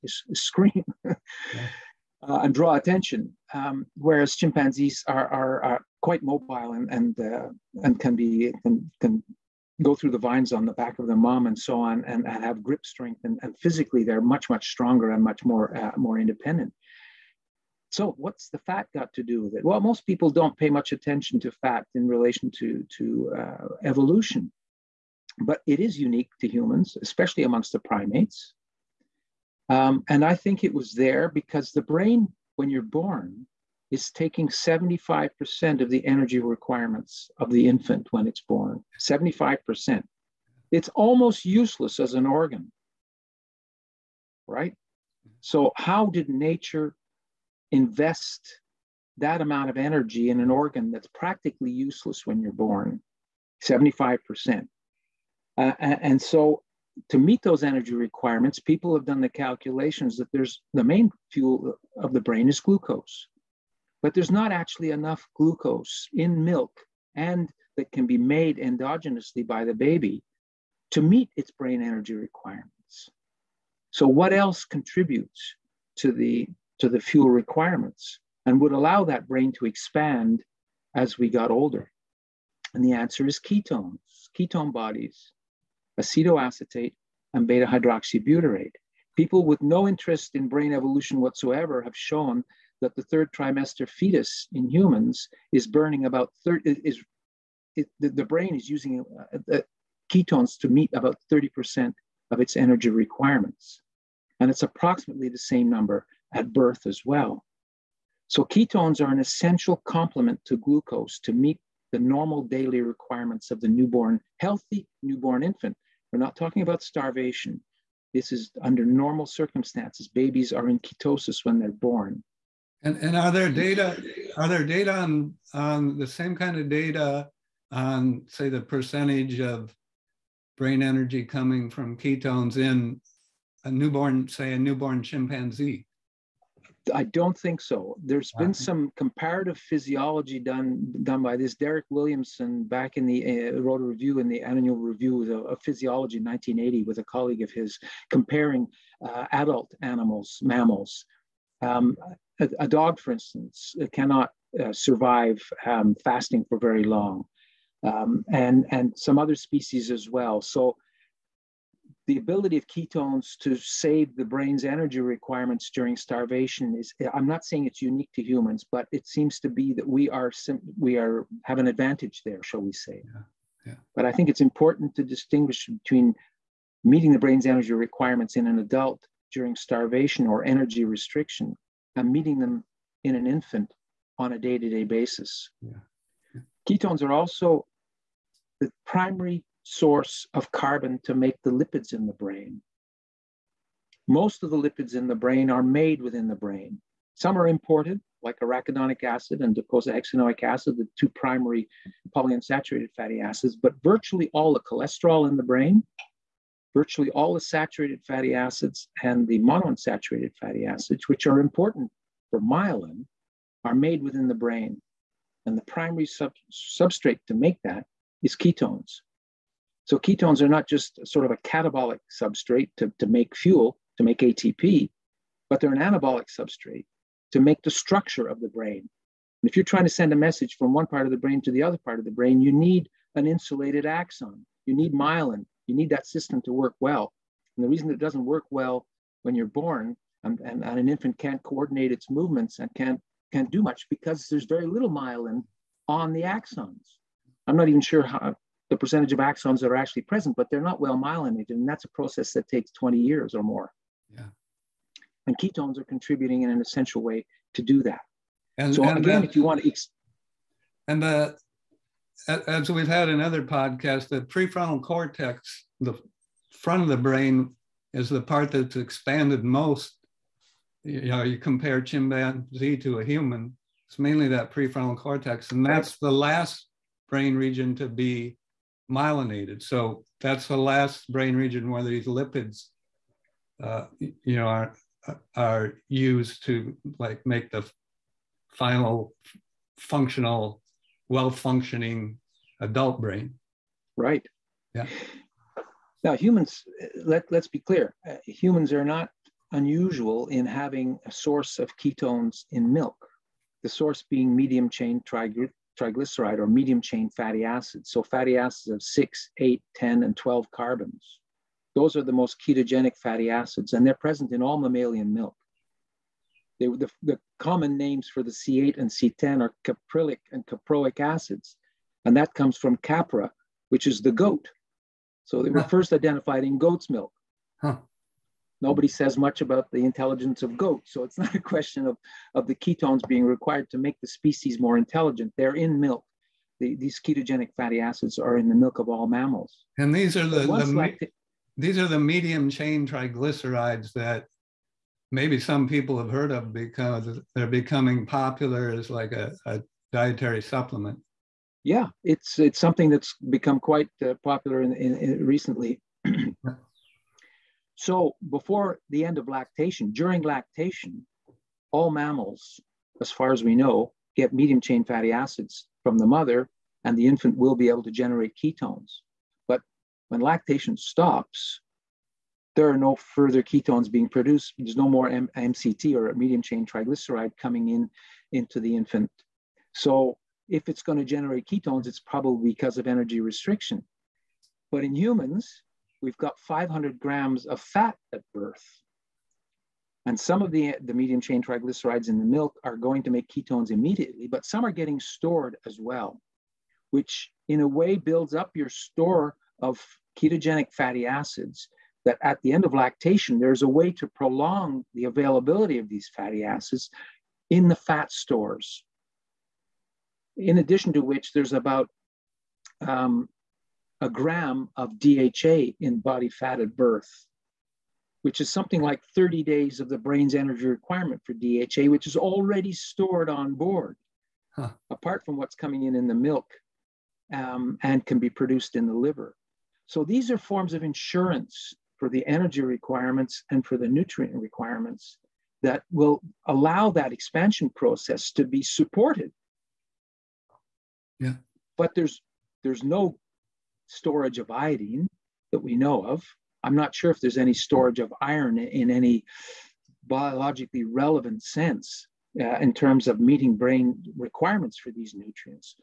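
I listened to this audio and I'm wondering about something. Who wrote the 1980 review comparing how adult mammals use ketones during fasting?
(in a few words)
Derek Williamson.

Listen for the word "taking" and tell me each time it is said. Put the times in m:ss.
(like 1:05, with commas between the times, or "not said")
0:34.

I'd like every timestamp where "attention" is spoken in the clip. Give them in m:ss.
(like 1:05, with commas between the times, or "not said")
0:02, 0:20.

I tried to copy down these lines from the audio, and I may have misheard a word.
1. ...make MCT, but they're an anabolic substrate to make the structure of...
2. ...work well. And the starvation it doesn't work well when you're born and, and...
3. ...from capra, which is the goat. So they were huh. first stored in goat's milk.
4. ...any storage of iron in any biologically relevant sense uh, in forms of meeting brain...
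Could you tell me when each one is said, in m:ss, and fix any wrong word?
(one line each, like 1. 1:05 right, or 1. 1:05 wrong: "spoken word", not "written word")
1. 3:44 wrong: "ATP", not "MCT"
2. 3:56 wrong: "reason", not "starvation"
3. 5:22 wrong: "identified", not "stored"
4. 7:27 wrong: "terms", not "forms".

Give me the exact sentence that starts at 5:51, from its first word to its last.
Yeah, it's it's something that's become quite uh, popular in, in, in recently.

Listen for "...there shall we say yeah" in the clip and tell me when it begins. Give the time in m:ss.
2:52.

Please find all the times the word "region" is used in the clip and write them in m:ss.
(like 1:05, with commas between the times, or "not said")
4:37, 4:41.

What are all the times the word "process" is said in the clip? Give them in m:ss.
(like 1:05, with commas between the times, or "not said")
4:11, 7:17.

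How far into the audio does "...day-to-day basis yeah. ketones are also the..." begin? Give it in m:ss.
3:04.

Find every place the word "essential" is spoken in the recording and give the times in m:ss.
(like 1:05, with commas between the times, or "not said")
1:49, 4:16.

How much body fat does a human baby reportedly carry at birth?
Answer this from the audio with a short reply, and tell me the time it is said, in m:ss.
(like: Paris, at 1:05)
500 grams, at 6:26.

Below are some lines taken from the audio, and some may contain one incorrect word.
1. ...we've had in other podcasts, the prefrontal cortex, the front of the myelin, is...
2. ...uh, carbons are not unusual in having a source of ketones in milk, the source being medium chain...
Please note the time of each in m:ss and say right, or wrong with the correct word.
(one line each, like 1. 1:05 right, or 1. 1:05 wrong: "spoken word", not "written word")
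1. 4:22 wrong: "brain", not "myelin"
2. 4:58 wrong: "humans", not "carbons".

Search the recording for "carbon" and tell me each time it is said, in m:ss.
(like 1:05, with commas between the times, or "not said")
3:10, 5:10.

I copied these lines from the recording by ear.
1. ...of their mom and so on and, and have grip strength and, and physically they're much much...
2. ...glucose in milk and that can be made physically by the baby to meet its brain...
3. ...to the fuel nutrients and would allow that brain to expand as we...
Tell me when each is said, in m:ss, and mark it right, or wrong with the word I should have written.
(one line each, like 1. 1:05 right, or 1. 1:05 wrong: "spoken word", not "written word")
1. 0:10 right
2. 1:05 wrong: "endogenously", not "physically"
3. 1:16 wrong: "requirements", not "nutrients".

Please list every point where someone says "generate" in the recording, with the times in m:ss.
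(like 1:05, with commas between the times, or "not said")
6:07, 6:21.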